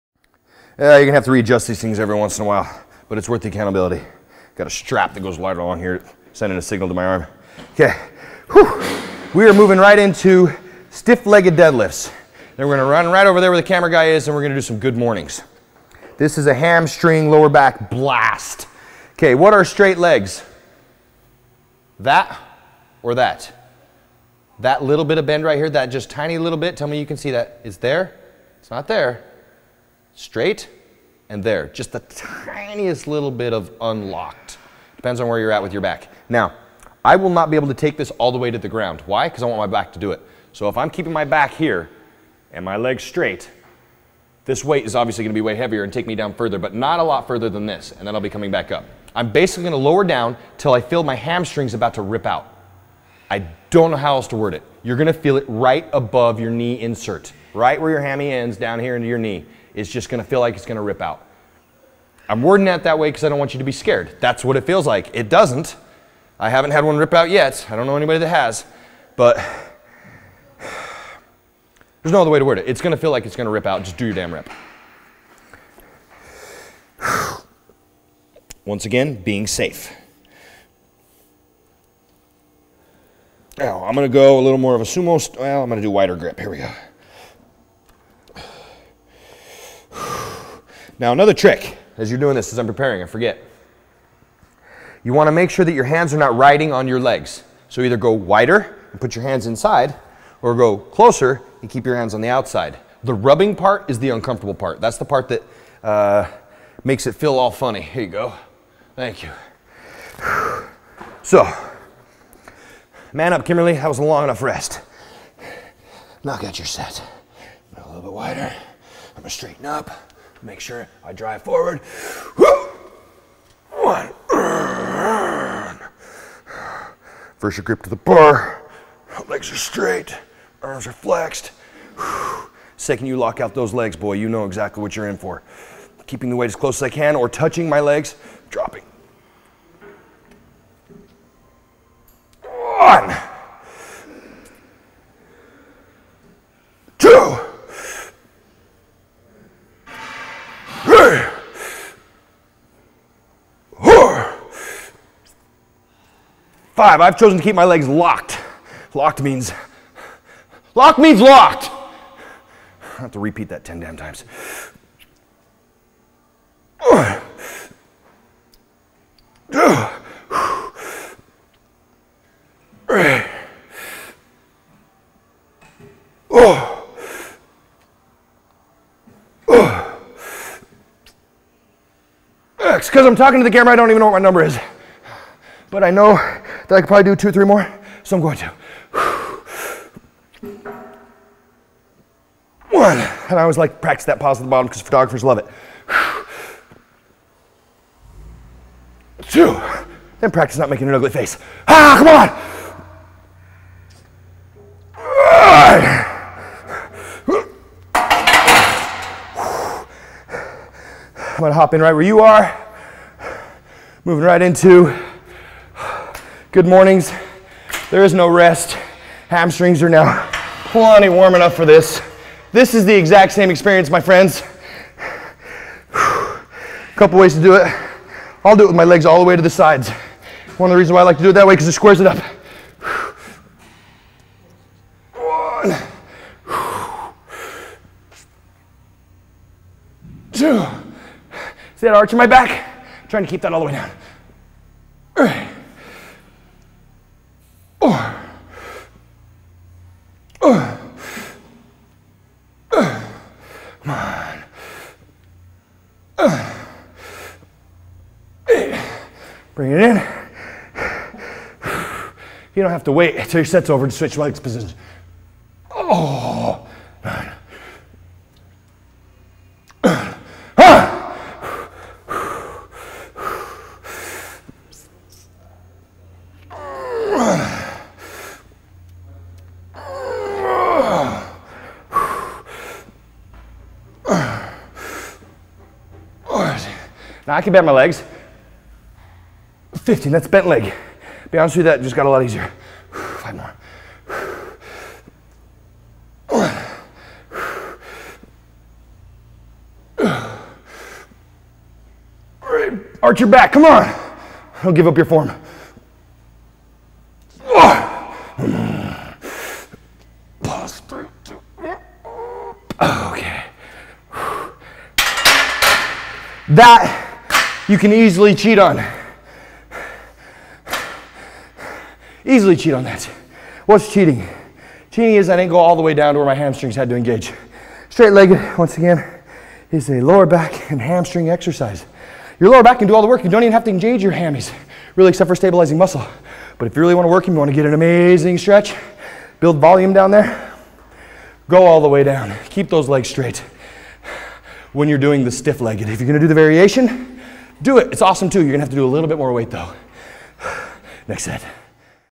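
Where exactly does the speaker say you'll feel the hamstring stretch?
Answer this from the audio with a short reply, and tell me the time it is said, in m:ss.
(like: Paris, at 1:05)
Right above your knee insert, at 0:55.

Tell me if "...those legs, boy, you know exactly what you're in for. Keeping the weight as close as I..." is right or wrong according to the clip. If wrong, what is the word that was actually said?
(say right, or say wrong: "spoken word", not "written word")
right.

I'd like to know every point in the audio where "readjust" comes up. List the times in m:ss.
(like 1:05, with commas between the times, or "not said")
0:01.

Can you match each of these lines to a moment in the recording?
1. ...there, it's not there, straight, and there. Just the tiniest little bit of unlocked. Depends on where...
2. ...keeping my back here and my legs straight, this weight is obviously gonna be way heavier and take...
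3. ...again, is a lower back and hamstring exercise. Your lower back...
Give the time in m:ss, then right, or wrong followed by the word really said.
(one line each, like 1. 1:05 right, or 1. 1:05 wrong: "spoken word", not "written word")
1. 0:27 right
2. 0:40 right
3. 5:28 right.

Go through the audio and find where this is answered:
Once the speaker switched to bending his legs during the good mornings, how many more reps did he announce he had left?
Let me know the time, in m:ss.
4:52.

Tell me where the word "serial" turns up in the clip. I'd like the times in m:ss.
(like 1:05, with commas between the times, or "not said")
not said.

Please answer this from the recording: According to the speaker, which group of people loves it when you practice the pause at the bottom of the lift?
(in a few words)
Photographers.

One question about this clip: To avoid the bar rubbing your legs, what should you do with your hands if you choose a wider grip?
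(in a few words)
Put your hands inside.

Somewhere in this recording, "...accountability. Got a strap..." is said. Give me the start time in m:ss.
0:03.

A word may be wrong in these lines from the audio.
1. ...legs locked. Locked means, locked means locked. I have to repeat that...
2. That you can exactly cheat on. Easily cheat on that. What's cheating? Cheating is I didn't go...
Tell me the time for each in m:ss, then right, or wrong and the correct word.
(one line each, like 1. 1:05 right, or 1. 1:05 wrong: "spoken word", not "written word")
1. 2:37 right
2. 5:16 wrong: "easily", not "exactly".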